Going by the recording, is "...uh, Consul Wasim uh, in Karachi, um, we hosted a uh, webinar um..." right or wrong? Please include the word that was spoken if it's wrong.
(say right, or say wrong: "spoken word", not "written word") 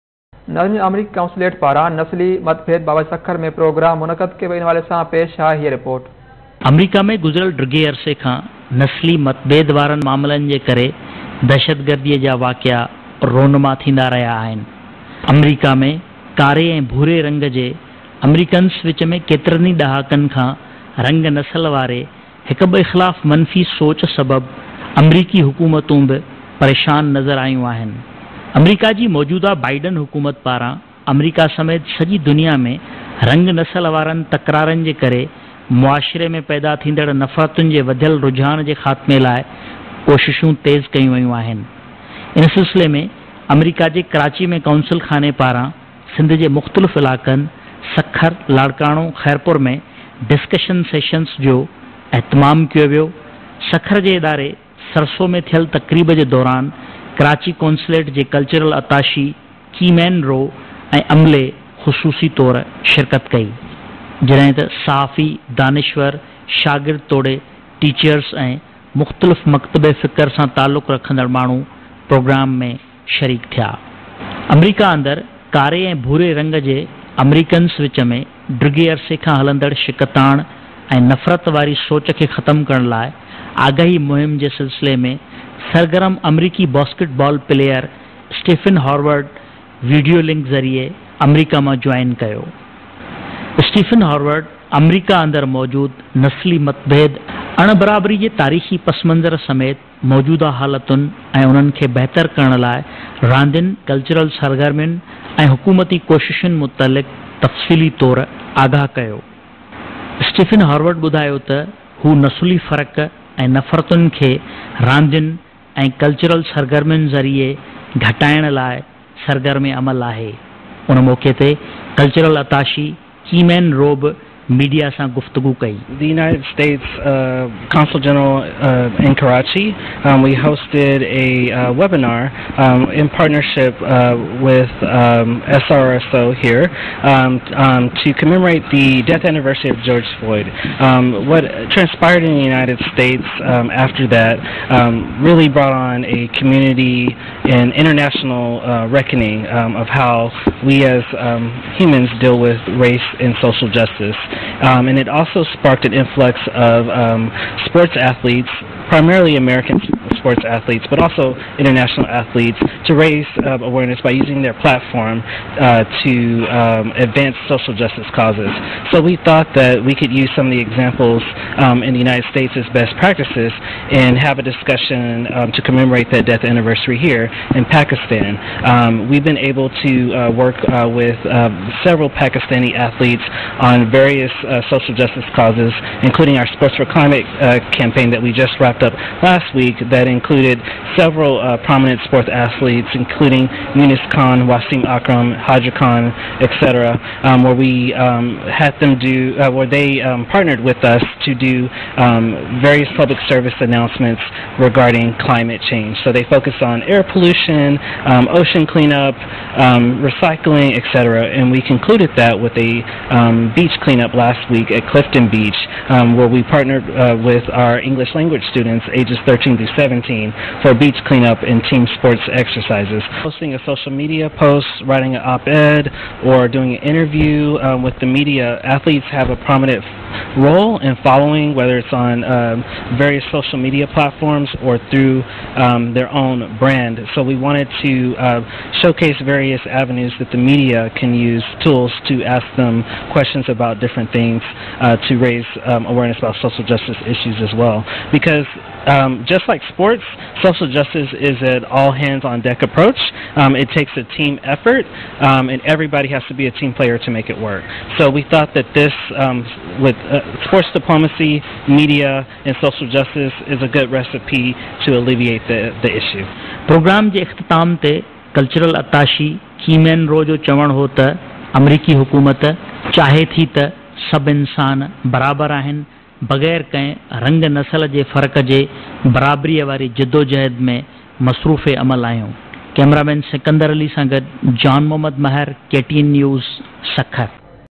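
wrong: "General", not "Wasim".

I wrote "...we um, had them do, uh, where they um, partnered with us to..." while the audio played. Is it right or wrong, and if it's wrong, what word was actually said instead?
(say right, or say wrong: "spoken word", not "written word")
right.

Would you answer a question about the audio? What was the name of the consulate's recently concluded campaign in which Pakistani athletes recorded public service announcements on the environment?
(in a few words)
Sports for Climate.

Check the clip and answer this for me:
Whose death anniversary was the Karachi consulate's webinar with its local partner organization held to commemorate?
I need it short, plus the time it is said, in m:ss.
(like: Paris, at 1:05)
George Floyd, at 2:19.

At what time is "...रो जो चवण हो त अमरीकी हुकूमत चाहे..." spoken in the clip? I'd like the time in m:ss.
4:30.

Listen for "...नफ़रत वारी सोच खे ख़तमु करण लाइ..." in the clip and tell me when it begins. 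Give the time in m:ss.
1:21.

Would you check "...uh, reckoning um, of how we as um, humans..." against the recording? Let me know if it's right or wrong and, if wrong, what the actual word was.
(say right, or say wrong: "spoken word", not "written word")
right.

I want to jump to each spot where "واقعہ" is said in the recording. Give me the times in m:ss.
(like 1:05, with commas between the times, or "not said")
0:12.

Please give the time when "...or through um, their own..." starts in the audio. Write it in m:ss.
3:54.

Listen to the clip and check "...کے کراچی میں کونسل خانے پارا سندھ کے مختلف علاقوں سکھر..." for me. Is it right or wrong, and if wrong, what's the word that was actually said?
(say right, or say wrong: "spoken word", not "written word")
right.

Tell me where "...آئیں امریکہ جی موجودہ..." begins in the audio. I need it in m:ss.
0:27.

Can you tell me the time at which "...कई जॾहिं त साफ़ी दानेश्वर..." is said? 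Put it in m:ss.
1:03.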